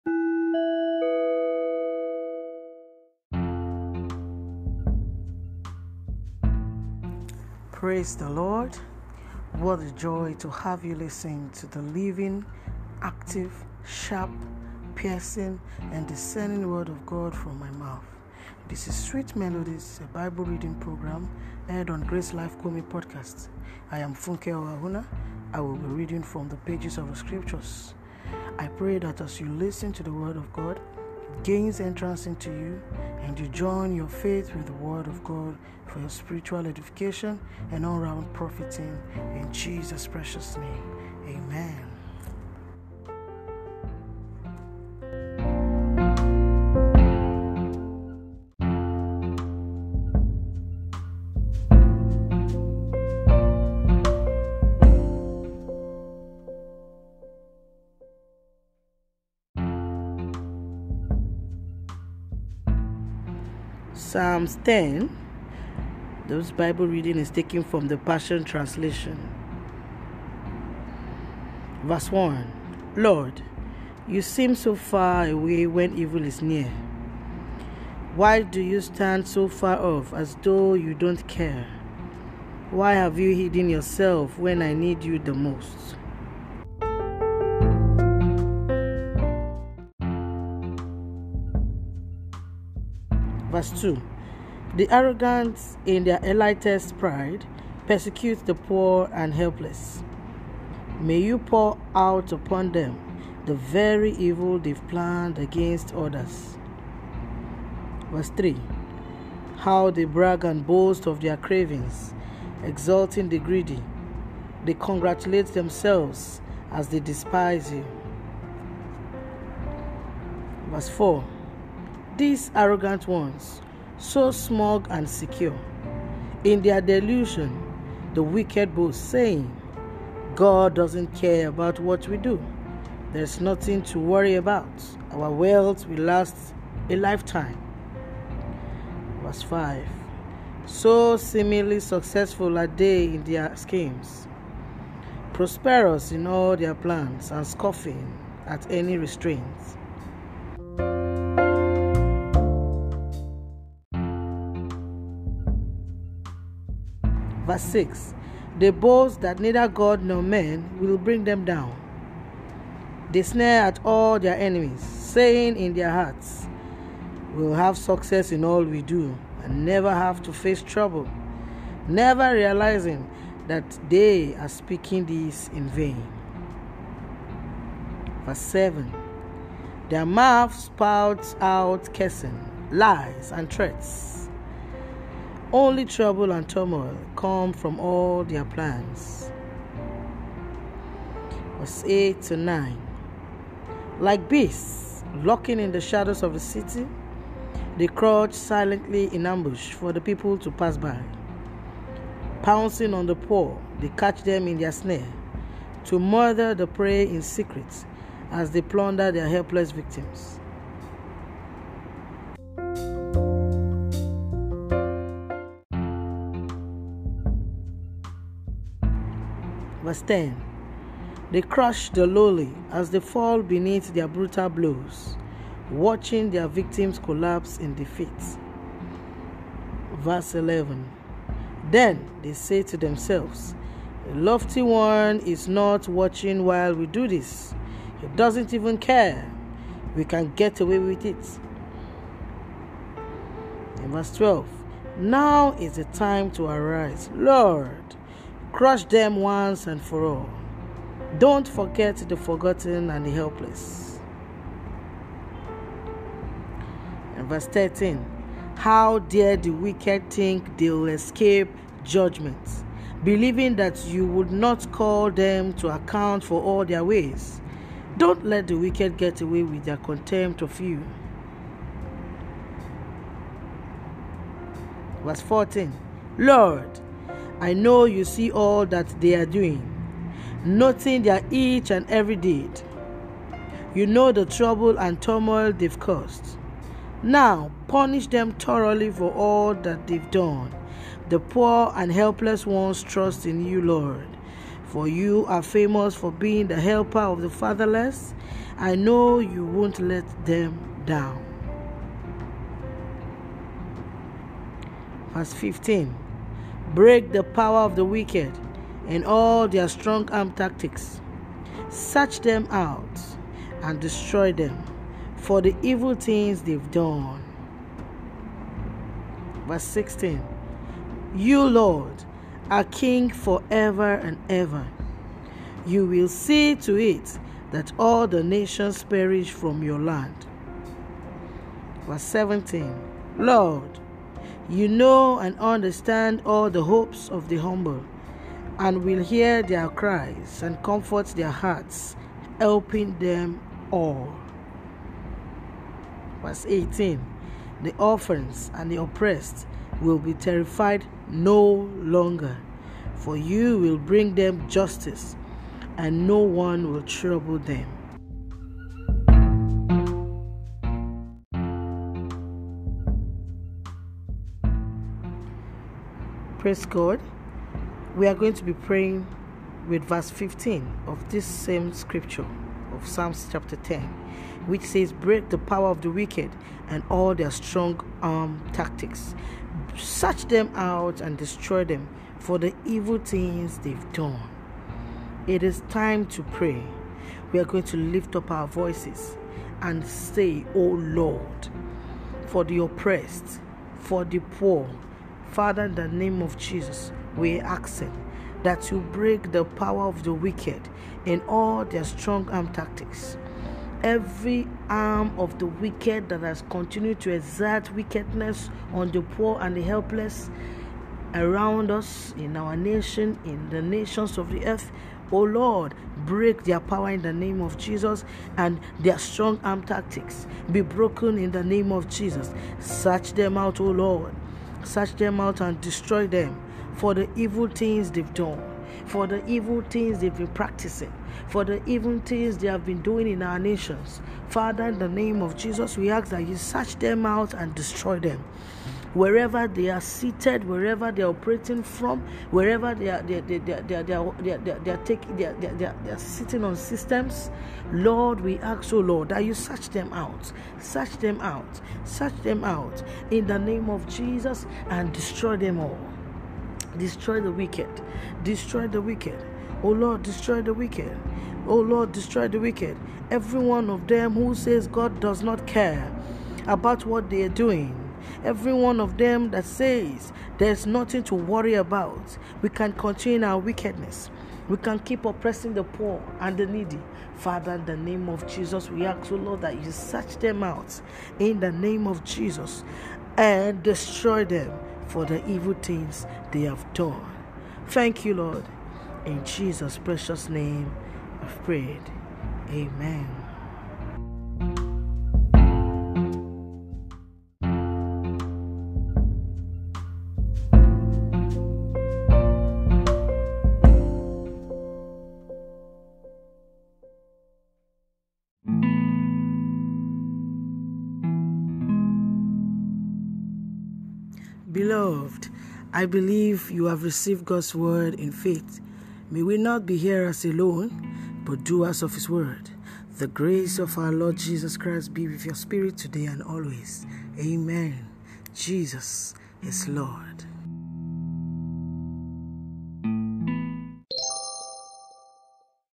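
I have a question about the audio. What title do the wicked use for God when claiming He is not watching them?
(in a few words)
The lofty one.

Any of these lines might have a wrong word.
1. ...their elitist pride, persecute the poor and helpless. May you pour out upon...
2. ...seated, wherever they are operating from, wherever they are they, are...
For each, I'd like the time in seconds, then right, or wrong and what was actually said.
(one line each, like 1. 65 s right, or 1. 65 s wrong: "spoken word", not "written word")
1. 96 s right
2. 439 s right.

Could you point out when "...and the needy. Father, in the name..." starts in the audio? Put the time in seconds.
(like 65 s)
476 s.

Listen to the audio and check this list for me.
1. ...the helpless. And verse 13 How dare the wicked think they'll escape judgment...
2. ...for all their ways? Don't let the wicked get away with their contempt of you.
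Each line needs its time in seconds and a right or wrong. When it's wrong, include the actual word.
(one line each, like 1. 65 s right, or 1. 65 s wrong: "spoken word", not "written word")
1. 253 s right
2. 266 s right.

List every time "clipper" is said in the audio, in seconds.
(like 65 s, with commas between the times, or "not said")
not said.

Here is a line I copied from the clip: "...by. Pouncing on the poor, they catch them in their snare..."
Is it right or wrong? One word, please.
right.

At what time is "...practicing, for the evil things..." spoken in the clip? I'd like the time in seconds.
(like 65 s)
430 s.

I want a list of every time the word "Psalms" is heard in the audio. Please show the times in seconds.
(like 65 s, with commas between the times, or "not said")
64 s, 372 s.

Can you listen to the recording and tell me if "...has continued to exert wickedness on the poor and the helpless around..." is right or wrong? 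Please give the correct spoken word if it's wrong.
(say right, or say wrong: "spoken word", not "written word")
right.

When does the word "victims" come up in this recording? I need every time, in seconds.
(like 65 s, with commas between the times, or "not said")
209 s, 226 s.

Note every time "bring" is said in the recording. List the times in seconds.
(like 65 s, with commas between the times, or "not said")
160 s, 353 s.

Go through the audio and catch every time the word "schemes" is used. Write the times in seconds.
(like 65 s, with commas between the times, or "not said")
143 s.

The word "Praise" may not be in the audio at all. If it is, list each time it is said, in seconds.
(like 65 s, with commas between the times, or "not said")
7 s, 366 s.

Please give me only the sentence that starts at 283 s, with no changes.
You know the trouble and turmoil they've caused.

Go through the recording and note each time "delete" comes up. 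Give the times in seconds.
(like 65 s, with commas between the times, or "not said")
not said.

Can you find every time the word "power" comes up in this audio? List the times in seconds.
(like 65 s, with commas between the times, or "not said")
307 s, 375 s, 399 s, 416 s.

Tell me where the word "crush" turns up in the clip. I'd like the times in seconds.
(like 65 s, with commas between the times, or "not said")
221 s, 248 s.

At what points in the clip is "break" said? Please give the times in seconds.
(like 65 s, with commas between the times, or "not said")
306 s, 374 s, 398 s, 416 s.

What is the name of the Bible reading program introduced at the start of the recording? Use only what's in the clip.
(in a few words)
Sweet Melodies.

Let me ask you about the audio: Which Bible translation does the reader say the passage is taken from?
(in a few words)
The Passion Translation.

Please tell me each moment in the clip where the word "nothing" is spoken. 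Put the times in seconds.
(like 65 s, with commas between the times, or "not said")
133 s, 470 s.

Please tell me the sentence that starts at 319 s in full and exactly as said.
Verse 16 You, Lord, are King forever and ever.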